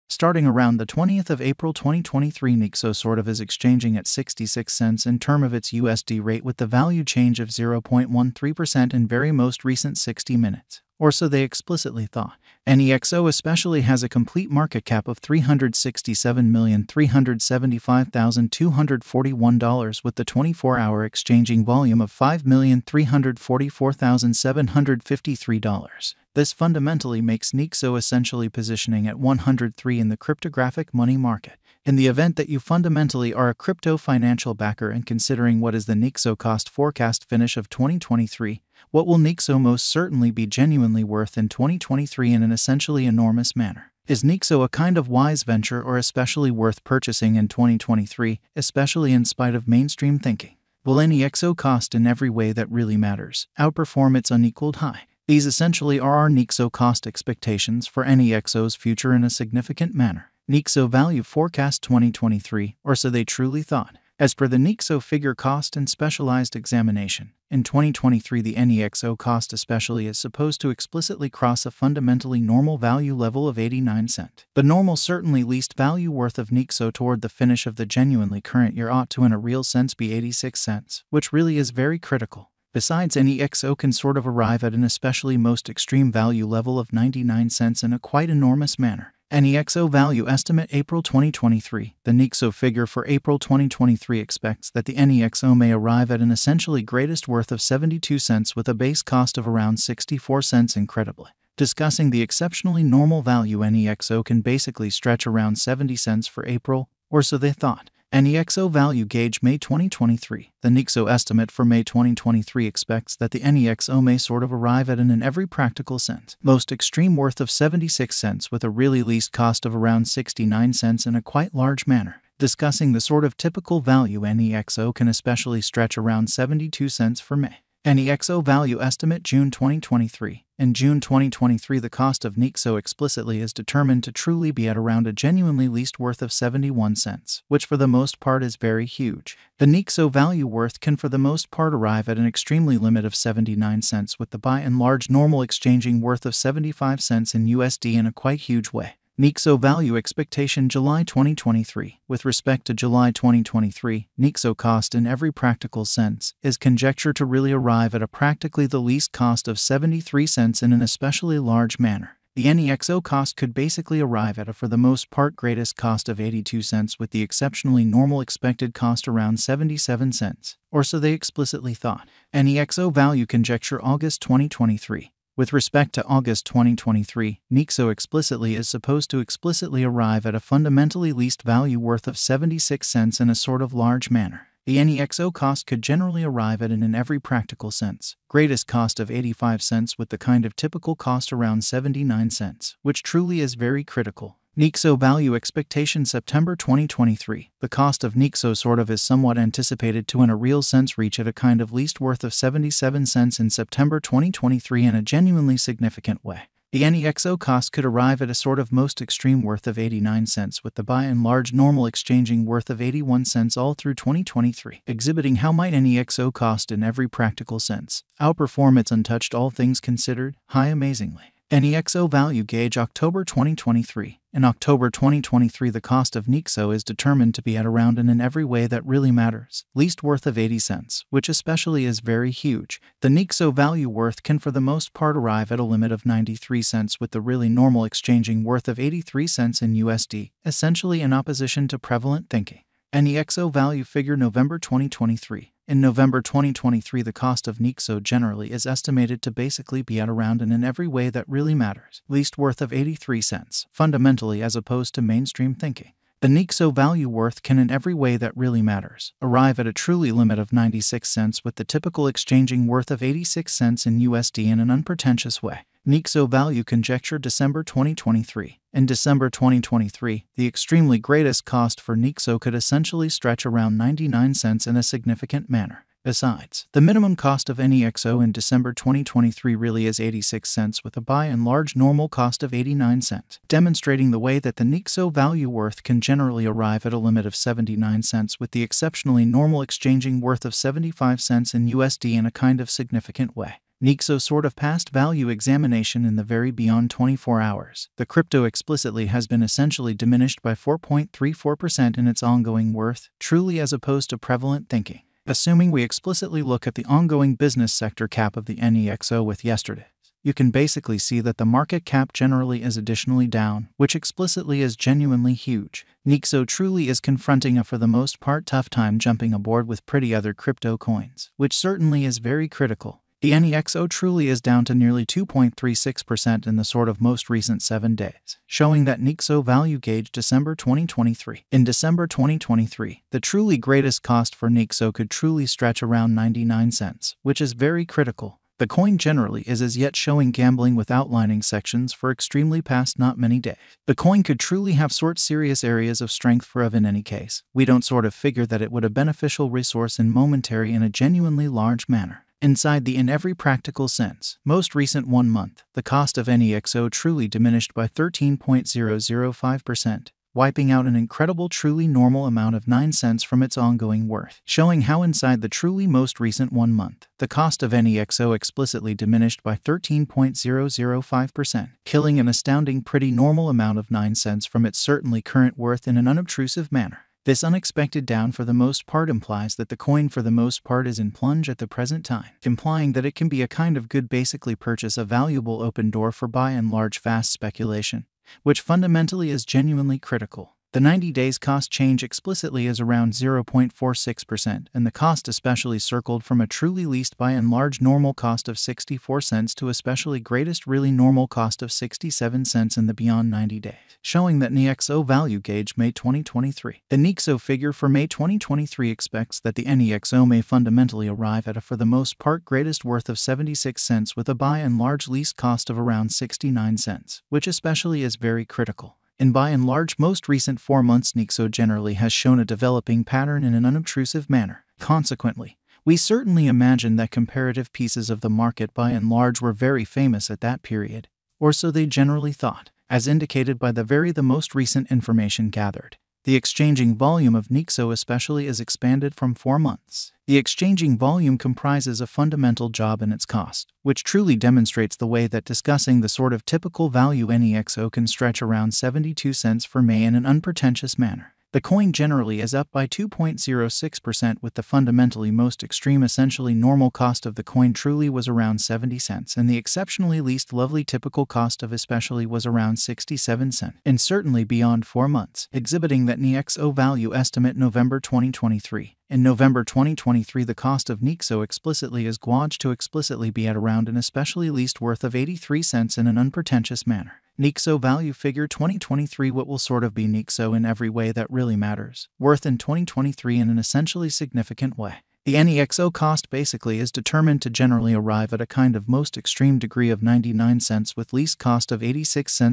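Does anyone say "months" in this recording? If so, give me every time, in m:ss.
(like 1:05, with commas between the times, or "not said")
5:55, 6:06, 7:00, 7:19, 7:45.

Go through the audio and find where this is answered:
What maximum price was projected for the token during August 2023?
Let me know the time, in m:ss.
3:09.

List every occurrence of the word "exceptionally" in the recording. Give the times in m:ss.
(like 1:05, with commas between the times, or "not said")
1:42, 2:47, 4:48, 7:39.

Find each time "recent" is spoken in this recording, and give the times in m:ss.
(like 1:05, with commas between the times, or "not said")
0:09, 5:27, 5:54, 6:06, 7:00, 7:14.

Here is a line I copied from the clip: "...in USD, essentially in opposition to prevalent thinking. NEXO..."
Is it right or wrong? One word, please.
right.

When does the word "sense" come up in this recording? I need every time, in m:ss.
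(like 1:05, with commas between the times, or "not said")
1:19, 1:55, 2:35, 3:07, 3:20, 3:37, 5:53.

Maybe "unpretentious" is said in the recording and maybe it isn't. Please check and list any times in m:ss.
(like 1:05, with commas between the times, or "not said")
4:24, 7:30, 7:56.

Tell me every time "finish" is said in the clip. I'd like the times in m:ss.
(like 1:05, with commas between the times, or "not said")
0:37, 1:17.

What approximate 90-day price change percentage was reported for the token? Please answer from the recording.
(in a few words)
0.46%.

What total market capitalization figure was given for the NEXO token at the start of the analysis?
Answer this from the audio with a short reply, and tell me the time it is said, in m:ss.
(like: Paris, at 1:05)
$367,375,241, at 0:15.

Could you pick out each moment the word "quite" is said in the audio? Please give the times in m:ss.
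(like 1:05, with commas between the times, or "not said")
1:27, 2:01, 2:28.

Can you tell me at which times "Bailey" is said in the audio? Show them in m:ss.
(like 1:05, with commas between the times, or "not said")
not said.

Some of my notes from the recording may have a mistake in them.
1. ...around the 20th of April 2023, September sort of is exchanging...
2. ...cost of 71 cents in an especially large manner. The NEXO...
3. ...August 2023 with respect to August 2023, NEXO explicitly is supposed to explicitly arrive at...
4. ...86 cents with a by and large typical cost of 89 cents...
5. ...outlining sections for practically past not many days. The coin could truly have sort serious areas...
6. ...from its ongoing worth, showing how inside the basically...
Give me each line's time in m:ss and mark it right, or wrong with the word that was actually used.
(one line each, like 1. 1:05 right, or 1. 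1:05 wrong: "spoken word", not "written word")
1. 0:00 wrong: "NEXO", not "September"
2. 2:39 wrong: "73", not "71"
3. 2:53 right
4. 4:39 wrong: "normal", not "typical"
5. 5:40 wrong: "extremely", not "practically"
6. 6:03 wrong: "truly", not "basically".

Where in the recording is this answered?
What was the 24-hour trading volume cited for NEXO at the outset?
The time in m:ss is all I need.
0:22.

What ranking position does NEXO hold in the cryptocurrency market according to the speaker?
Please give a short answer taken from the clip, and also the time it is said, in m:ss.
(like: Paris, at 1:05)
103, at 0:29.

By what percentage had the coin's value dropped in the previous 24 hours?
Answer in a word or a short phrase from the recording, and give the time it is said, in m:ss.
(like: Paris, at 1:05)
4.34%, at 5:00.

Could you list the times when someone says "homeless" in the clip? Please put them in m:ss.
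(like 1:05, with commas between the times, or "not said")
not said.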